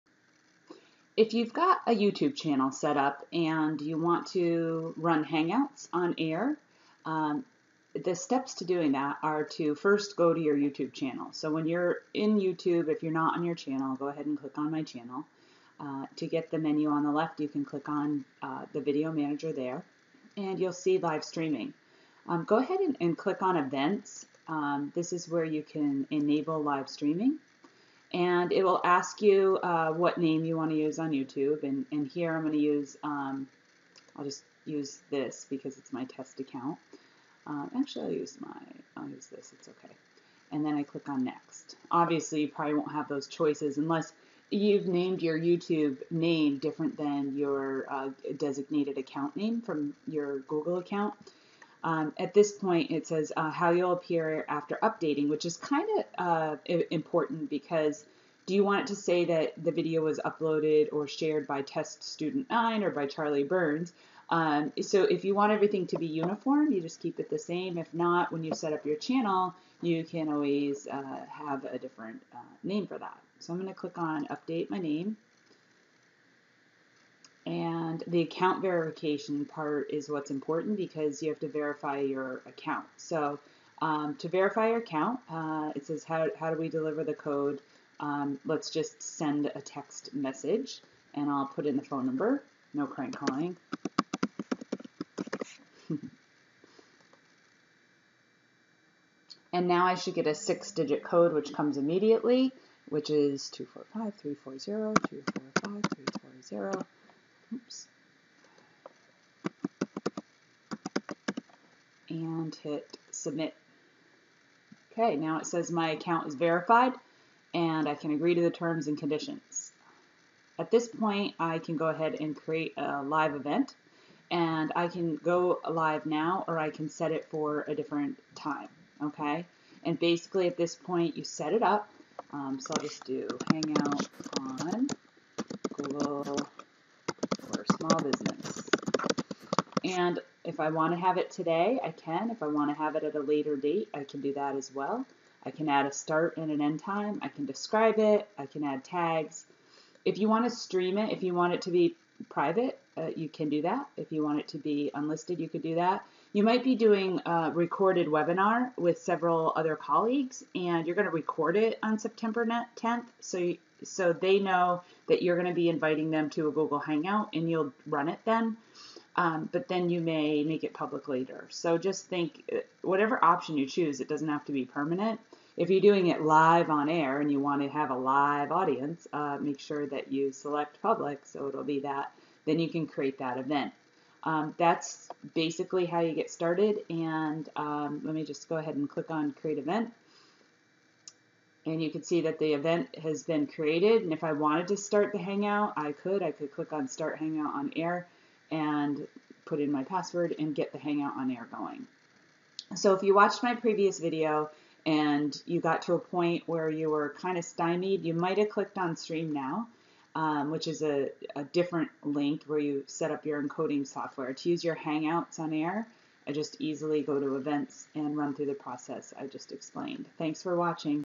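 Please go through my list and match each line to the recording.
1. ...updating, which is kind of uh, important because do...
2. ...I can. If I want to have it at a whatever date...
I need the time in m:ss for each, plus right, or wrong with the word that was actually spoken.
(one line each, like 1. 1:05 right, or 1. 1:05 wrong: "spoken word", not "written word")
1. 0:54 right
2. 2:21 wrong: "later", not "whatever".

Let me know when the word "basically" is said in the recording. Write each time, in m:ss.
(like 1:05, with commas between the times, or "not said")
2:09, 3:05.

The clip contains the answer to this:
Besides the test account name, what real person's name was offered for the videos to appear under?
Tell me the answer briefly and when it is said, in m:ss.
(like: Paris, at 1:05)
Charlie Burns, at 1:03.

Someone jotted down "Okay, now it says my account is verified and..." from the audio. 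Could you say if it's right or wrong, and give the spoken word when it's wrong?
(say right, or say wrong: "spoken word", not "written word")
right.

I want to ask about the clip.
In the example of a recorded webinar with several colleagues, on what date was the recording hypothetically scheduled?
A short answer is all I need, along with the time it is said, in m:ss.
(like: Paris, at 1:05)
September 10th, at 2:41.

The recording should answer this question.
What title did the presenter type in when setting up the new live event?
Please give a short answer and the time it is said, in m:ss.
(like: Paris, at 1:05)
Hangout on Google for small business, at 2:13.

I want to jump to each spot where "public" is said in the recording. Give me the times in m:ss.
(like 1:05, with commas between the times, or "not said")
2:50, 3:00.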